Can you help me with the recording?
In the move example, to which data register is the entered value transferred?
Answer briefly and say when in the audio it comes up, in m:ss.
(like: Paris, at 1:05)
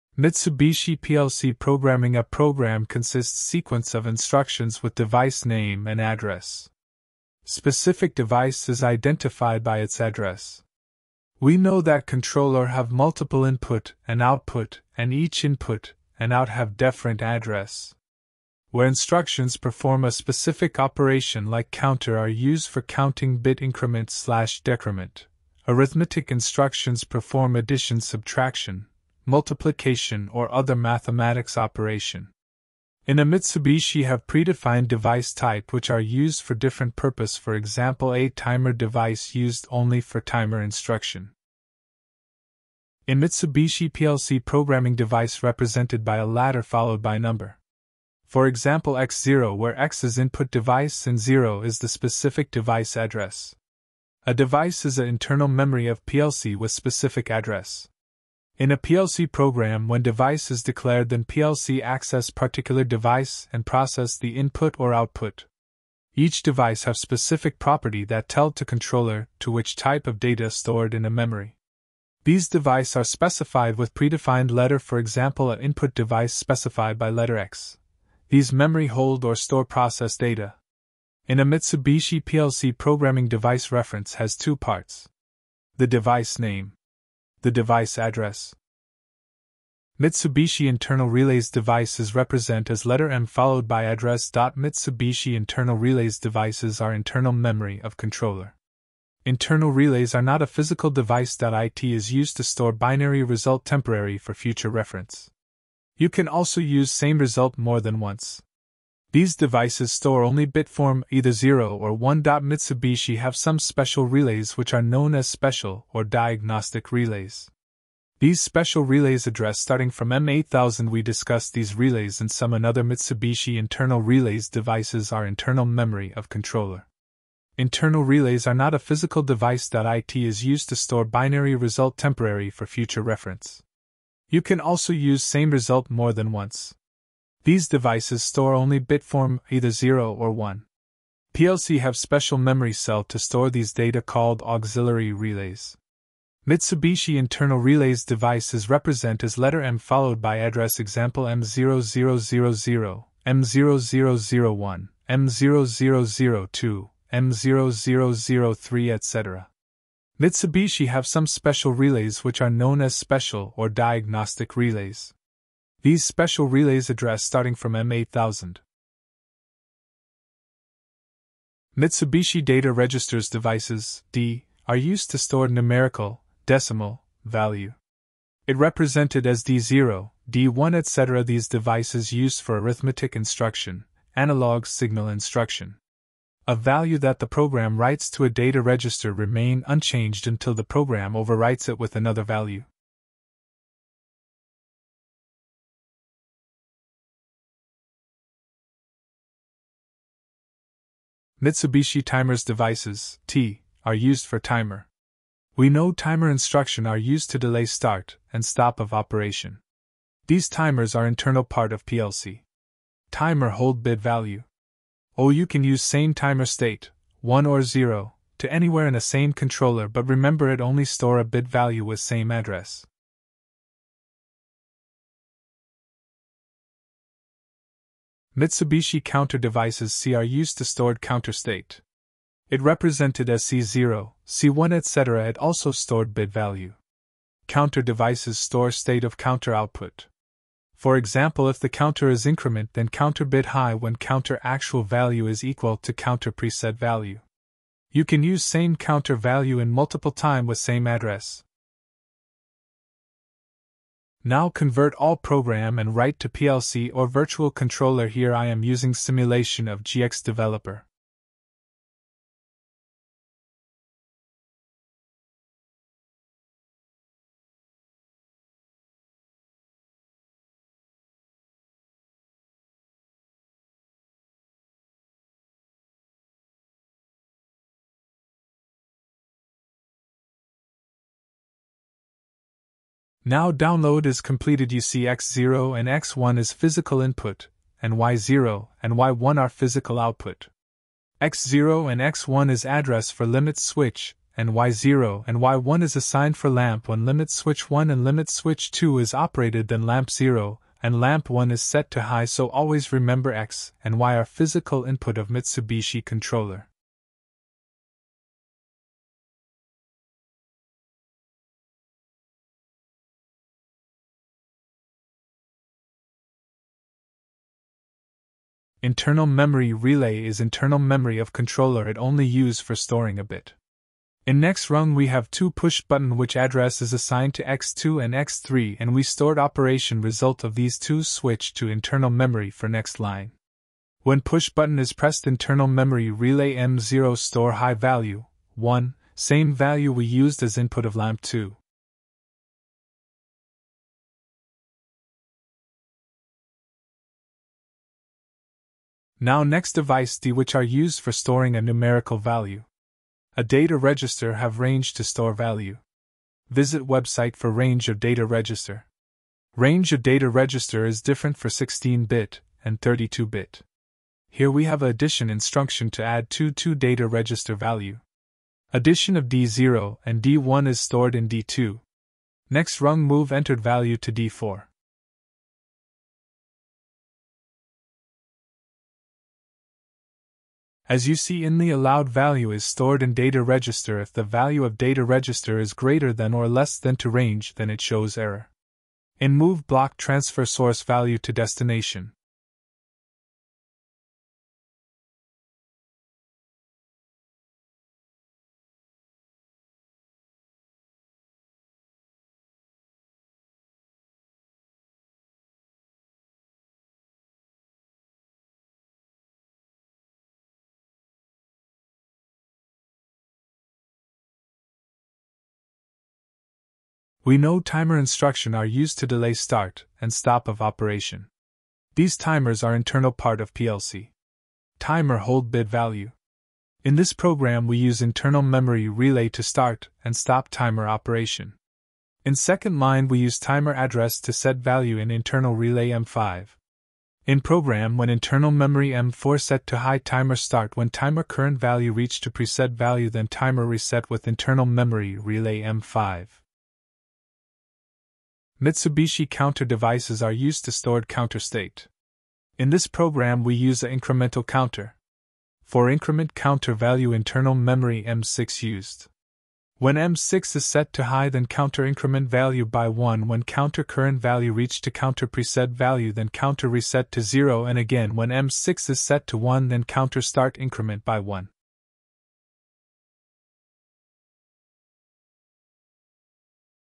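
D4, at 6:14.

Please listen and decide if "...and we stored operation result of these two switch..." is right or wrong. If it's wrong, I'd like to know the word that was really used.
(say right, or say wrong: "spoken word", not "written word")
right.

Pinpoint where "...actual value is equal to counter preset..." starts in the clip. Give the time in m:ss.
4:04.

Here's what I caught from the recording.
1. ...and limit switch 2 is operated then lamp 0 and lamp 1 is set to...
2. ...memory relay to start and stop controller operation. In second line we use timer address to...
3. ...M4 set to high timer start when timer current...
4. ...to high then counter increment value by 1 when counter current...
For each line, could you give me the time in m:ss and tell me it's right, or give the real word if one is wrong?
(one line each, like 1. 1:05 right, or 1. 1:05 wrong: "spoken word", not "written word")
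1. 4:57 right
2. 7:08 wrong: "timer", not "controller"
3. 7:18 right
4. 7:40 right.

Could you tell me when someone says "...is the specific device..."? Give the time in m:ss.
0:51.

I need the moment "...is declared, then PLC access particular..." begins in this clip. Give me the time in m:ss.
1:00.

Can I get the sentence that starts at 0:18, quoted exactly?
Where instructions perform a specific operation like counter are used for counting bit increment slash decrement.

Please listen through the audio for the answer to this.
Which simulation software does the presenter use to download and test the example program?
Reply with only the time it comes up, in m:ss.
4:19.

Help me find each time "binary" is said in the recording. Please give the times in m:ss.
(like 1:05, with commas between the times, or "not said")
1:42, 2:11.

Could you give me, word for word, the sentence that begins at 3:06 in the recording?
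A value that the program writes to a data register remain unchanged until the program overwrites it with another value.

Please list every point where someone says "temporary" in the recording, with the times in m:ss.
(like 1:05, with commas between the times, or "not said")
1:43, 2:11.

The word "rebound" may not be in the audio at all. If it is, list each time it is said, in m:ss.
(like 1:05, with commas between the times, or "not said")
not said.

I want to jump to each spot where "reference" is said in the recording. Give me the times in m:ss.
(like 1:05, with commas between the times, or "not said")
1:23, 1:44, 2:13.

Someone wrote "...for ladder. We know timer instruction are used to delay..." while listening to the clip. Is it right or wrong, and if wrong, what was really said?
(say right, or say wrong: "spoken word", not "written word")
wrong: "timer", not "ladder".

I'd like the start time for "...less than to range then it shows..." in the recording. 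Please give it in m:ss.
6:26.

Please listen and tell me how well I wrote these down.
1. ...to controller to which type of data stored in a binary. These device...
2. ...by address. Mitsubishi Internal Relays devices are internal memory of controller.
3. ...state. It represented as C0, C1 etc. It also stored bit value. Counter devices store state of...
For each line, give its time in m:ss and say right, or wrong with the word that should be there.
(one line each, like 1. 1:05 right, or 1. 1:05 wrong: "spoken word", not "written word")
1. 1:08 wrong: "memory", not "binary"
2. 1:33 right
3. 3:51 right.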